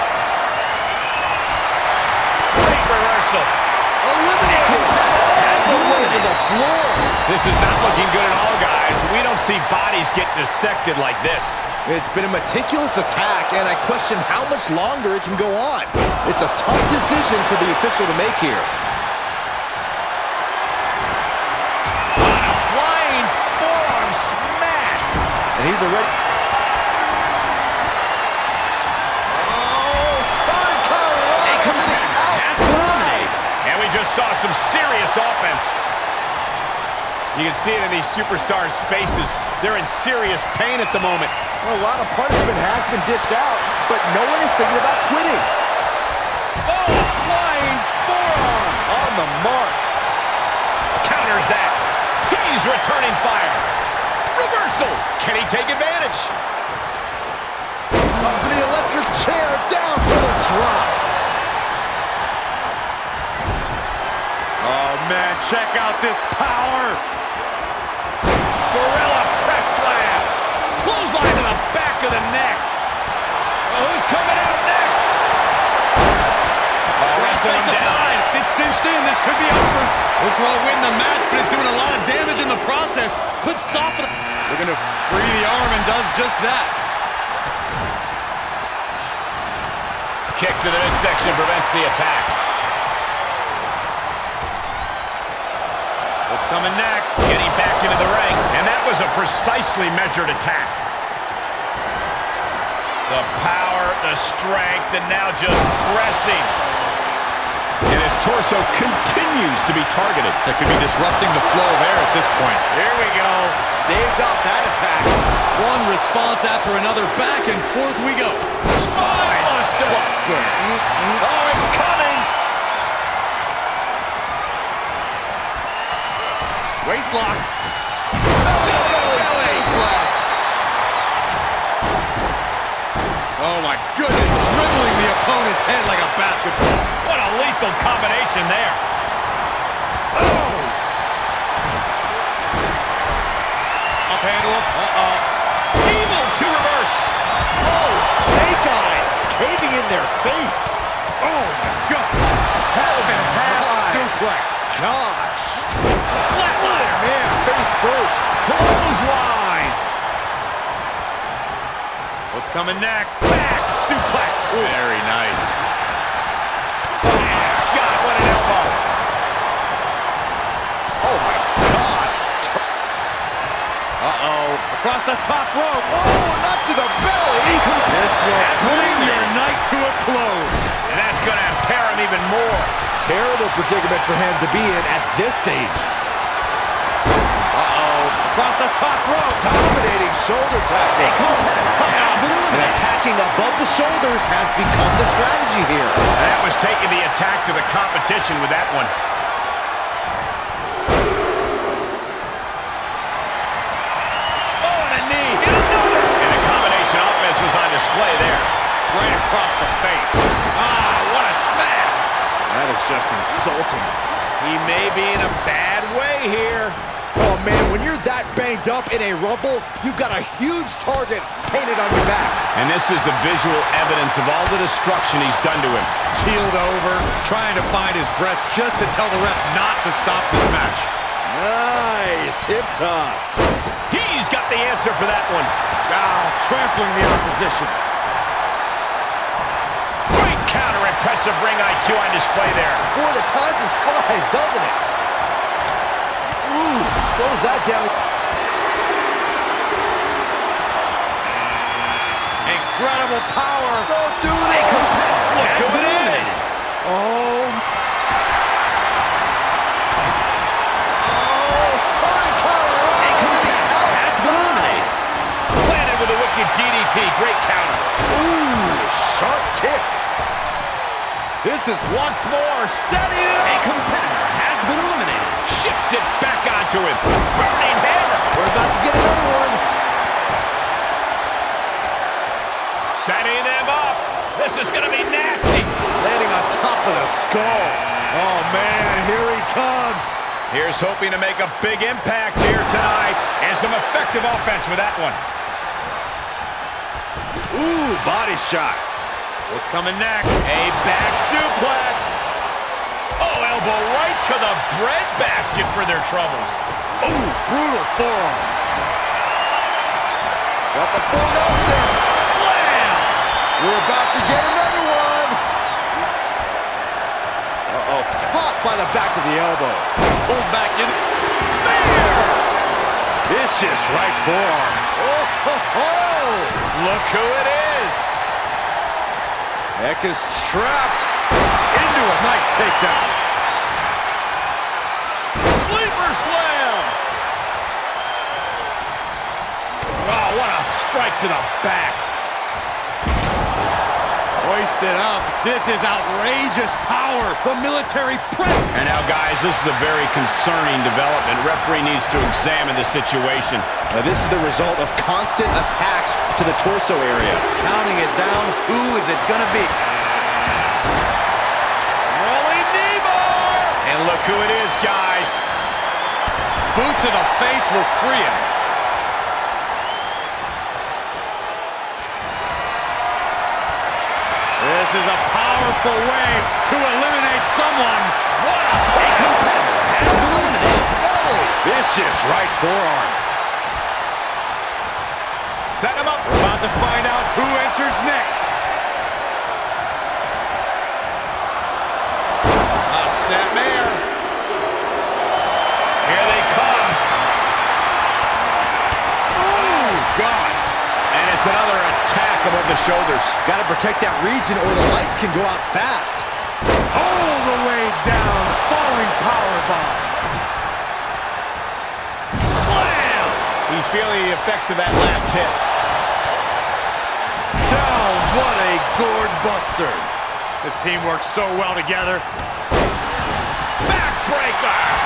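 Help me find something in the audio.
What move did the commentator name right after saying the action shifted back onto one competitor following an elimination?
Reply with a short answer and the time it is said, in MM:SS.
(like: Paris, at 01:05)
Burning hammer, at 04:37.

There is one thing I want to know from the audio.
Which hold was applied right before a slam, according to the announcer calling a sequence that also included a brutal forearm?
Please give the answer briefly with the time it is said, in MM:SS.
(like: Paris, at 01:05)
Full Nelson, at 05:11.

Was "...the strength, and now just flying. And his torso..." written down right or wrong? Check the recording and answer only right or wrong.
wrong.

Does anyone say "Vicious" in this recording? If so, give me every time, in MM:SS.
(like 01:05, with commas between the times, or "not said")
05:23, 06:21.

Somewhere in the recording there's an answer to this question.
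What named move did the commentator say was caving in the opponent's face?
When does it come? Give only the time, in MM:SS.
02:28.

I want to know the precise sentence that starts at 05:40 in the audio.
Wow, oh, what a strike to the back.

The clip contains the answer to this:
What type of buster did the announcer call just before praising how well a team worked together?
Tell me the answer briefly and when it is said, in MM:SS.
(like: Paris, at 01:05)
Gourd buster, at 06:58.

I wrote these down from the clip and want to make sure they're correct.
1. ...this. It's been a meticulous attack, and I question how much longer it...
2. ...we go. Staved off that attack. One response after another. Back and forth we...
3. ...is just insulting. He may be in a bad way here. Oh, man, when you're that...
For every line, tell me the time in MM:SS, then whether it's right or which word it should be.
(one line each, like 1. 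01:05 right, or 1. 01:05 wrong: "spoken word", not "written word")
1. 00:11 right
2. 01:53 right
3. 03:32 right.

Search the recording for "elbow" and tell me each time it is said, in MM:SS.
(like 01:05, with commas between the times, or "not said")
02:48, 05:03, 05:19.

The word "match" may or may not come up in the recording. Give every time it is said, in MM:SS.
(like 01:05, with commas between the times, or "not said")
01:20, 03:50.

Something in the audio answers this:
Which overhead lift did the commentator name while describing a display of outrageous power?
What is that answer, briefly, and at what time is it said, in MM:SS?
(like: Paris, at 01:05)
Military press, at 05:47.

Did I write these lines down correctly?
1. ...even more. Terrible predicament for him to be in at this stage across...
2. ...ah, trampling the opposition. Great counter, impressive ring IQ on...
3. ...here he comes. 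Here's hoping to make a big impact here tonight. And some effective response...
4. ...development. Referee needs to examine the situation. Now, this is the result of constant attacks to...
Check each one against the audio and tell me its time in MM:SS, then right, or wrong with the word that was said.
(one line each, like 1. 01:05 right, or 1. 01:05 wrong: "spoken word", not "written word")
1. 03:02 right
2. 03:56 right
3. 04:49 wrong: "offense", not "response"
4. 05:50 right.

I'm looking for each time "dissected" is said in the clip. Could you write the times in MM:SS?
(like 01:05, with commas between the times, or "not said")
00:10.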